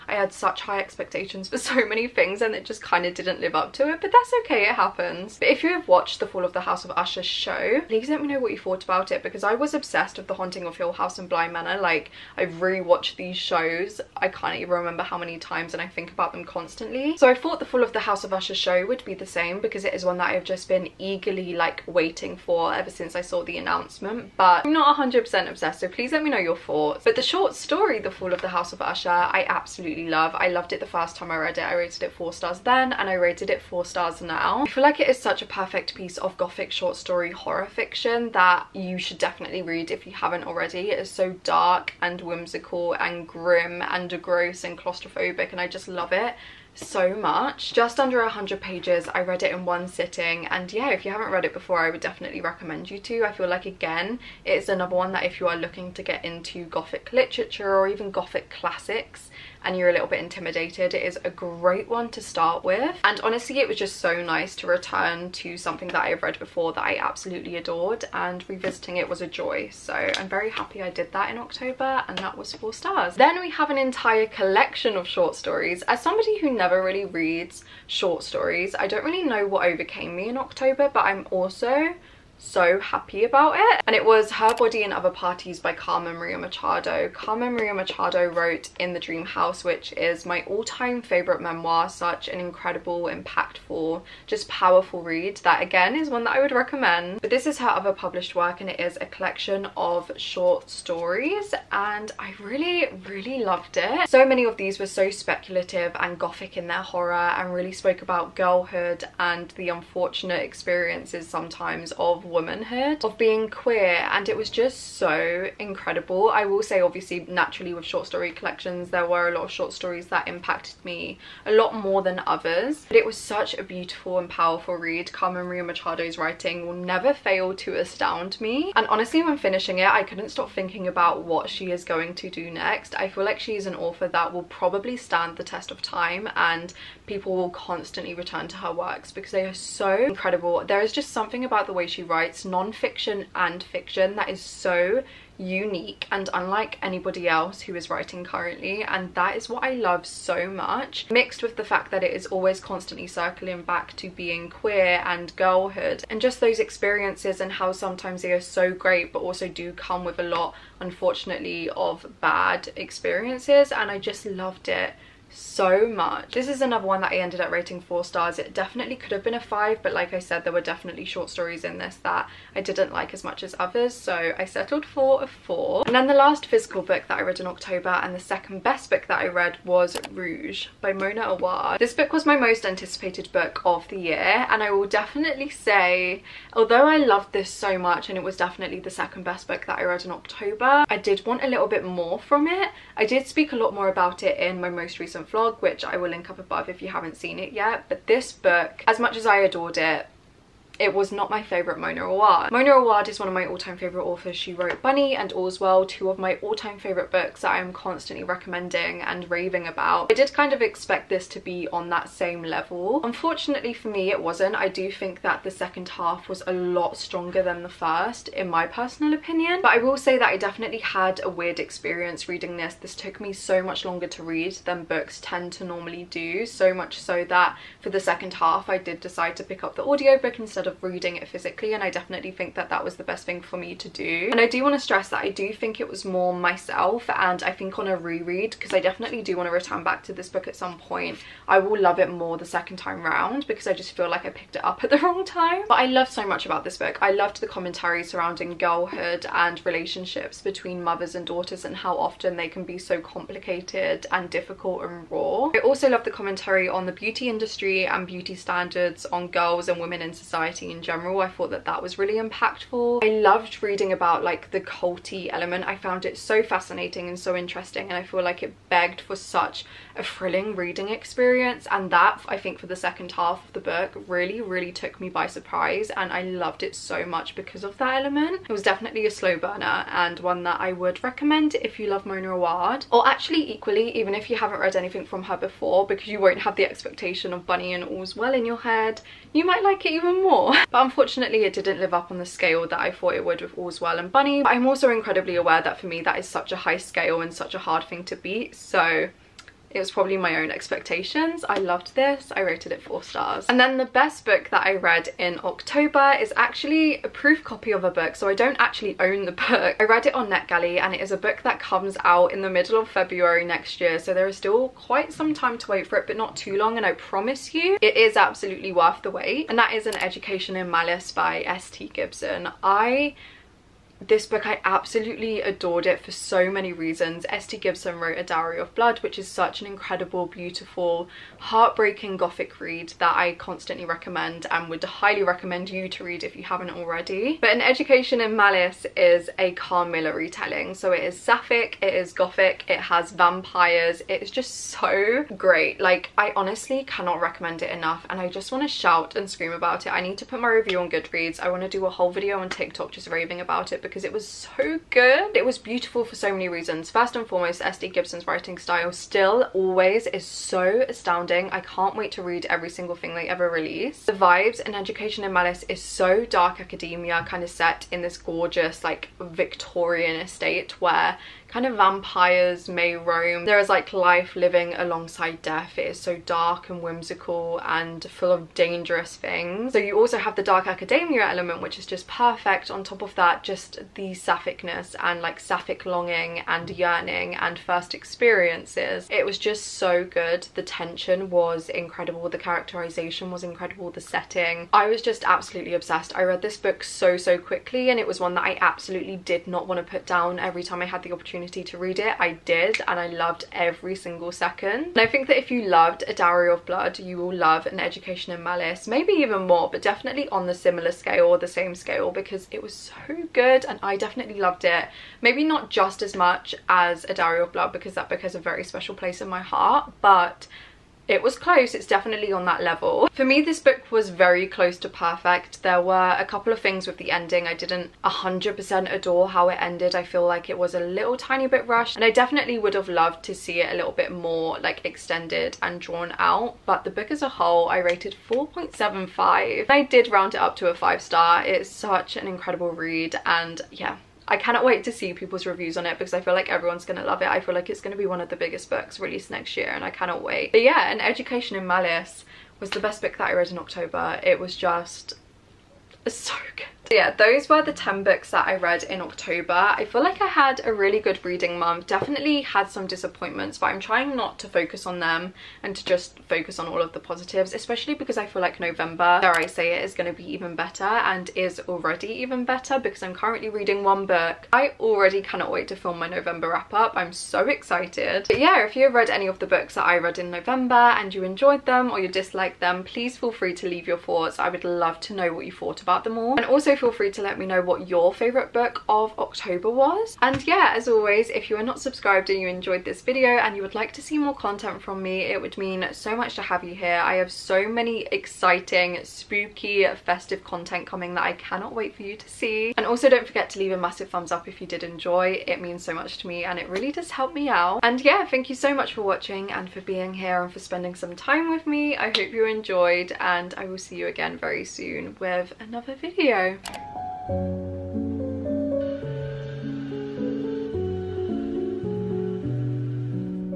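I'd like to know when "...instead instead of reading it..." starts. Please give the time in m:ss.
3:50.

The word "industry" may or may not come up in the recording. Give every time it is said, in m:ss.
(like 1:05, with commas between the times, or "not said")
4:17.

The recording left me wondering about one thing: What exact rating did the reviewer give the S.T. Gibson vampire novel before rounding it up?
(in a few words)
4.75.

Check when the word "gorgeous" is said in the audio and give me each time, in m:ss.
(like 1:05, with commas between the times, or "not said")
6:08.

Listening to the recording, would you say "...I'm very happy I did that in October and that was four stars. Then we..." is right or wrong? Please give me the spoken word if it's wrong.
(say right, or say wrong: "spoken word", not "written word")
right.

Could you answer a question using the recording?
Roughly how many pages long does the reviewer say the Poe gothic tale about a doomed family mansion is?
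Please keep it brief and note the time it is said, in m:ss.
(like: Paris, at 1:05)
Just under 100, at 0:47.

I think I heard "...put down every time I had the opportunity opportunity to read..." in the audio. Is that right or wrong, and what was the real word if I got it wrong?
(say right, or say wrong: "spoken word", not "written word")
right.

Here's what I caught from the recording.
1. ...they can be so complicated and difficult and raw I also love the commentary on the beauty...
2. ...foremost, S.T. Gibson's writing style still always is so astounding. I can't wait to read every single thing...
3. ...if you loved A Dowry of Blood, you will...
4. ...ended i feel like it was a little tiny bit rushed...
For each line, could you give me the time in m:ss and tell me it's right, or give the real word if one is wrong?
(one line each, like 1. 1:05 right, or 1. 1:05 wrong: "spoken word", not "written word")
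1. 4:12 right
2. 5:57 right
3. 6:45 right
4. 7:09 right.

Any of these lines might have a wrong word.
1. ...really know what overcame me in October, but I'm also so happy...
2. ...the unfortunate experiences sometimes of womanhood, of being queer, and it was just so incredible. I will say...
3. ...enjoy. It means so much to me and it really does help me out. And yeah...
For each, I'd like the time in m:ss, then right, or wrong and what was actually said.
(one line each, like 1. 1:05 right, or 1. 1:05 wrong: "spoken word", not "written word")
1. 1:19 right
2. 1:49 right
3. 8:24 right.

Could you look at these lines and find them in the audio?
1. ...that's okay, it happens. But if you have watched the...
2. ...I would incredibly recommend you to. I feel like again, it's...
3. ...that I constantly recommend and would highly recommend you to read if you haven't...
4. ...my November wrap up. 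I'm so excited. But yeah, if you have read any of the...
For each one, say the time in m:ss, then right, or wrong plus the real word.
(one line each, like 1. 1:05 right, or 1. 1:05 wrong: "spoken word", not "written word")
1. 0:04 right
2. 0:51 wrong: "definitely", not "incredibly"
3. 5:32 right
4. 7:55 right.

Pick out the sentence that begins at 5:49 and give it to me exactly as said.
I need to put my review on Goodreads.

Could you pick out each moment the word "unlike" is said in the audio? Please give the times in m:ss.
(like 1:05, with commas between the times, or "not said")
2:26.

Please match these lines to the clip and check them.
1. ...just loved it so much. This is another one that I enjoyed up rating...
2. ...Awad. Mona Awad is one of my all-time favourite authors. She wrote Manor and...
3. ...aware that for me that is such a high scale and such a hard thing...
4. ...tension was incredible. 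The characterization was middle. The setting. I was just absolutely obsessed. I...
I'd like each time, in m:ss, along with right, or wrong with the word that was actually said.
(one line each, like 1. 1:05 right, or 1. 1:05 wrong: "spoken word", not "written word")
1. 2:43 wrong: "ended", not "enjoyed"
2. 3:22 wrong: "Bunny", not "Manor"
3. 4:55 right
4. 6:30 wrong: "incredible", not "middle".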